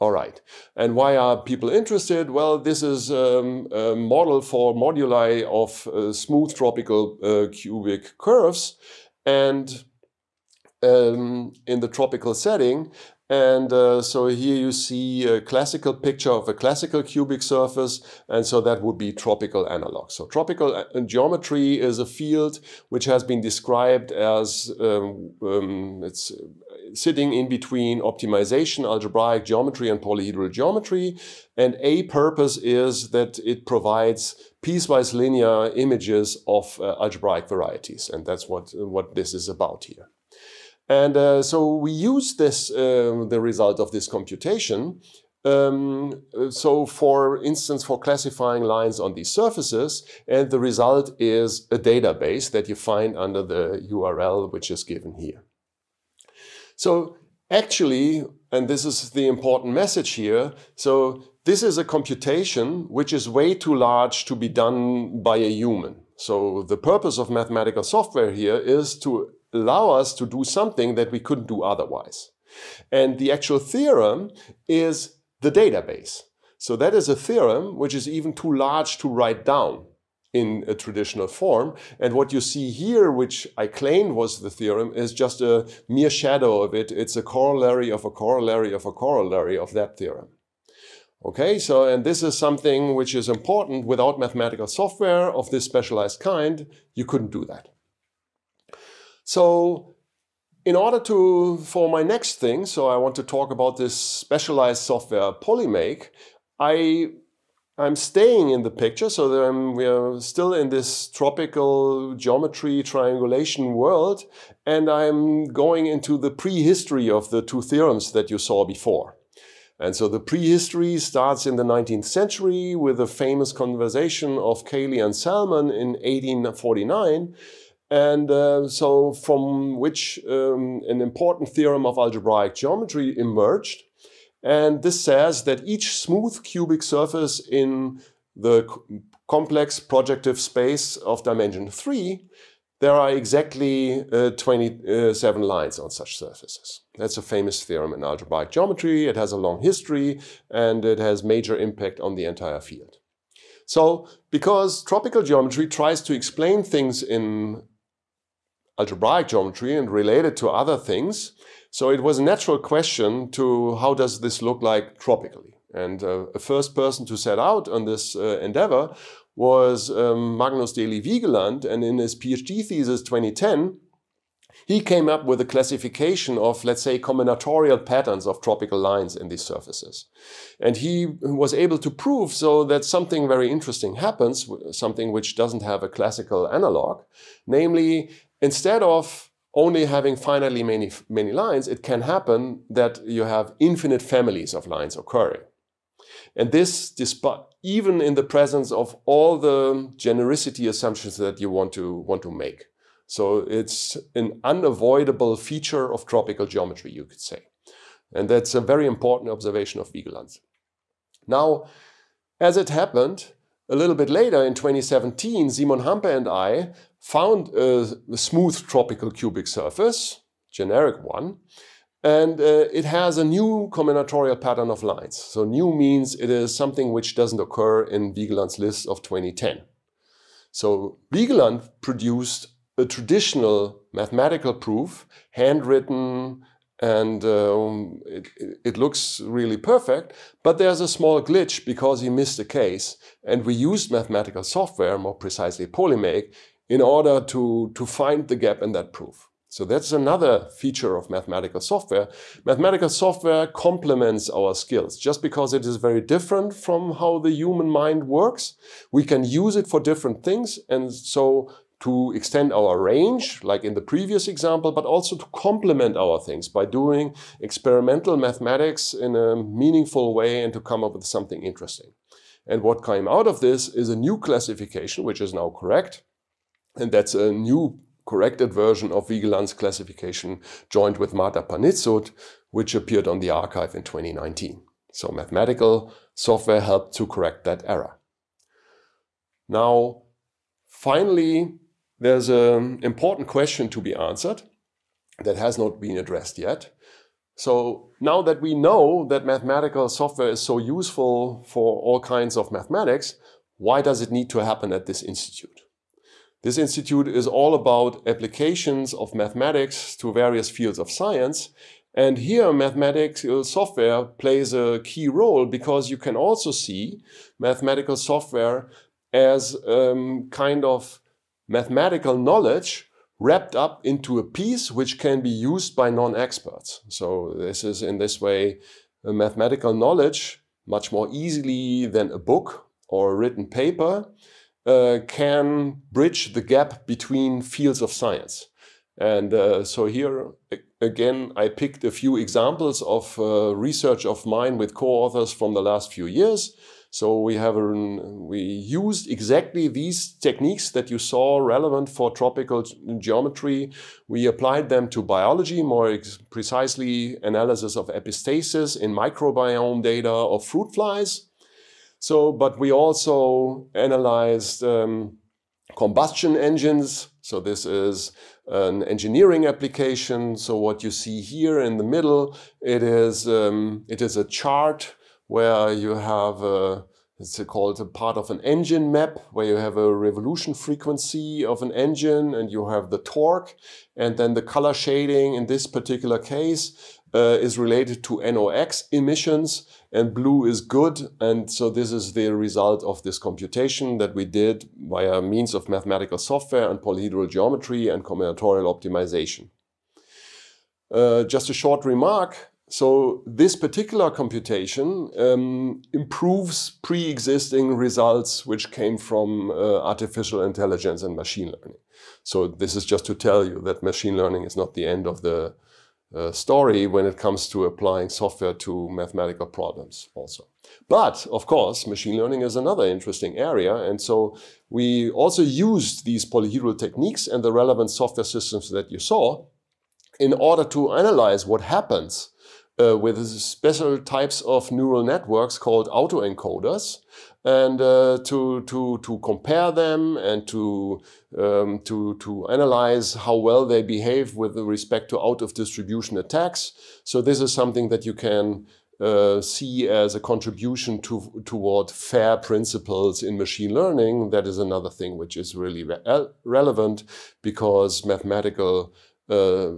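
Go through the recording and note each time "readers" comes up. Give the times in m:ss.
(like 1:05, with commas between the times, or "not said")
not said.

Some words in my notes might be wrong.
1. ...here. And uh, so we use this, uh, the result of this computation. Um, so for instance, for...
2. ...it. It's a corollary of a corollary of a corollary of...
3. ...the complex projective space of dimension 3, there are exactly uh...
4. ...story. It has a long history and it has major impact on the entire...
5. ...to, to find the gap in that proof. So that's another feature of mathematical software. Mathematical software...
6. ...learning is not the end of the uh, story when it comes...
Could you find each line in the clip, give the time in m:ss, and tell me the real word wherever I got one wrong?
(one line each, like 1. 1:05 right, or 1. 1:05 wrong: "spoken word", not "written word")
1. 0:39 right
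2. 1:26 right
3. 2:18 right
4. 2:28 wrong: "geometry", not "story"
5. 4:07 right
6. 6:54 right.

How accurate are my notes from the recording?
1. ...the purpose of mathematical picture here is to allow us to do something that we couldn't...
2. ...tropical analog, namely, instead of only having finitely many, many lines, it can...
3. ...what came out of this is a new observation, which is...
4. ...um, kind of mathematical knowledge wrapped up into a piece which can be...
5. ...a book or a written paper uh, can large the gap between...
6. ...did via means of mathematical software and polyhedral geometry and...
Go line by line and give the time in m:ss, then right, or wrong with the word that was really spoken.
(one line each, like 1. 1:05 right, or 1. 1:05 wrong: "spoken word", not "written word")
1. 1:06 wrong: "software", not "picture"
2. 3:05 wrong: "classical", not "tropical"
3. 4:32 wrong: "classification", not "observation"
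4. 5:19 right
5. 5:32 wrong: "bridge", not "large"
6. 6:34 right.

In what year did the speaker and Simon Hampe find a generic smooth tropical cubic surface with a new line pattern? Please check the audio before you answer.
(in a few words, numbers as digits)
2017.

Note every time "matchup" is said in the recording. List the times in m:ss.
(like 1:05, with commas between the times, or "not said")
not said.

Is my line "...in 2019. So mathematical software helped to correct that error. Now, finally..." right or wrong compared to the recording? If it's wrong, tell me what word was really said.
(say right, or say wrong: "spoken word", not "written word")
right.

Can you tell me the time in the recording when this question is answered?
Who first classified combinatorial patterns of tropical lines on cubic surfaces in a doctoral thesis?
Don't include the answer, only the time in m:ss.
2:50.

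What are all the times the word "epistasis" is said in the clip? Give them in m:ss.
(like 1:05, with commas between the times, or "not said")
5:57.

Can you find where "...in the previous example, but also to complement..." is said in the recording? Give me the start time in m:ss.
4:23.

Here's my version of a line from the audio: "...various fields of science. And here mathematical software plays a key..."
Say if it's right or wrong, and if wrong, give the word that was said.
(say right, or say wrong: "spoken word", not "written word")
right.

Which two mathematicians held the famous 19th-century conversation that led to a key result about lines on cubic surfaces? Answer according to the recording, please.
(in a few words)
Cayley and Salmon.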